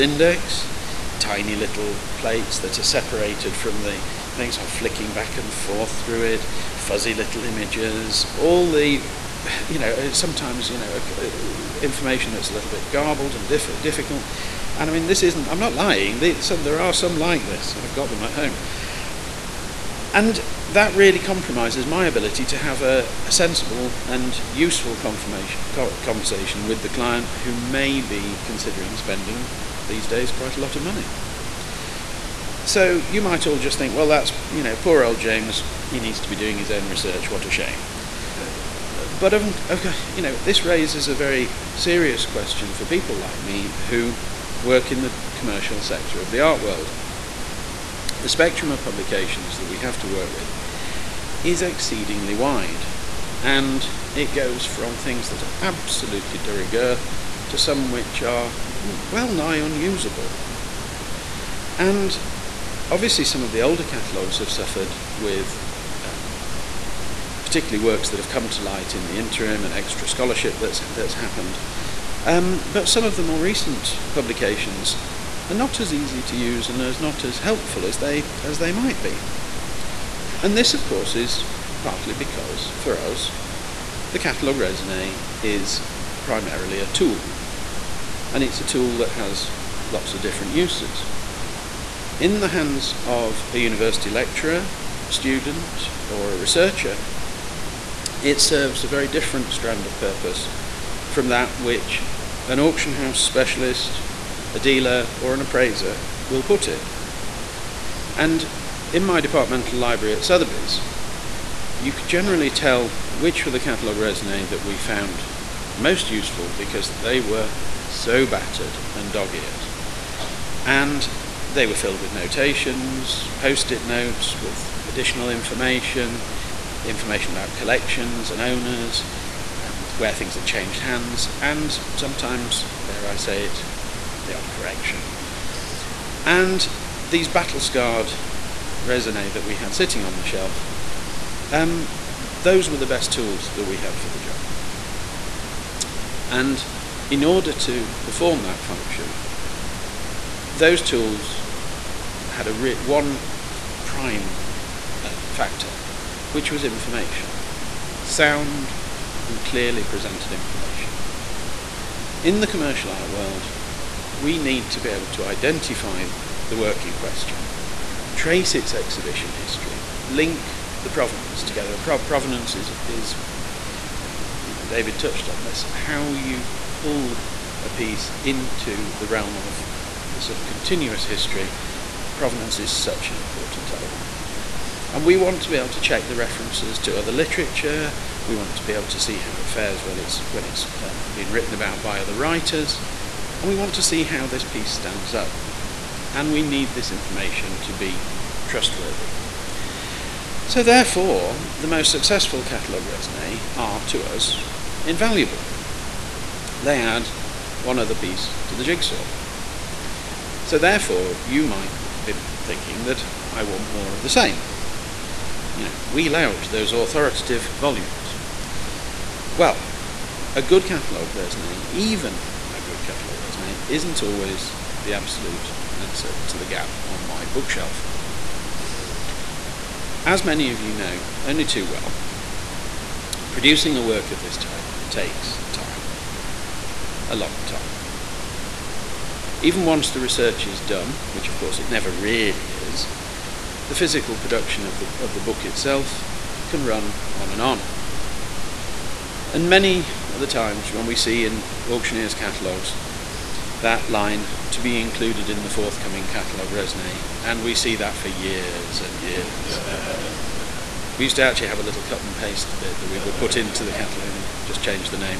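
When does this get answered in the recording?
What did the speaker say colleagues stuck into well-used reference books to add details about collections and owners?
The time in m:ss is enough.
2:03.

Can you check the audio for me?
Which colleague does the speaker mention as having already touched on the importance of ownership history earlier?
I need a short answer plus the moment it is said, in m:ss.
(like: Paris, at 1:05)
David, at 2:54.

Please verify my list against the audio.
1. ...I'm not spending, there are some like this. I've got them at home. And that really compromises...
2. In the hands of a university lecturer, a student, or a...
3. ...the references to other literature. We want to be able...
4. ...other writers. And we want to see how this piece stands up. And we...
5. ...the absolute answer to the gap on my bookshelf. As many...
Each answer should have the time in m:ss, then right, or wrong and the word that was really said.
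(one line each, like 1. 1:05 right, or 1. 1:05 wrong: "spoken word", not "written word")
1. 0:15 wrong: "lying", not "spending"
2. 1:32 right
3. 3:06 right
4. 3:12 right
5. 3:44 right.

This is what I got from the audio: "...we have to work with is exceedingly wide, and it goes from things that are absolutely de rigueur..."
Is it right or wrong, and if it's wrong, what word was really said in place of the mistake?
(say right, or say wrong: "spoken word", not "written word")
right.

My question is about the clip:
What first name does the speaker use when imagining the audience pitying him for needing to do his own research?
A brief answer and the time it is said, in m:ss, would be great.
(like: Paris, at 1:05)
James, at 0:35.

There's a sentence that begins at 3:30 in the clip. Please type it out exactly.
So therefore, you might be thinking that I want more of the same you know, wheel out those authoritative volumes.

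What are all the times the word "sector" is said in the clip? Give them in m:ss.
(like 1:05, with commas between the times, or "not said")
0:45.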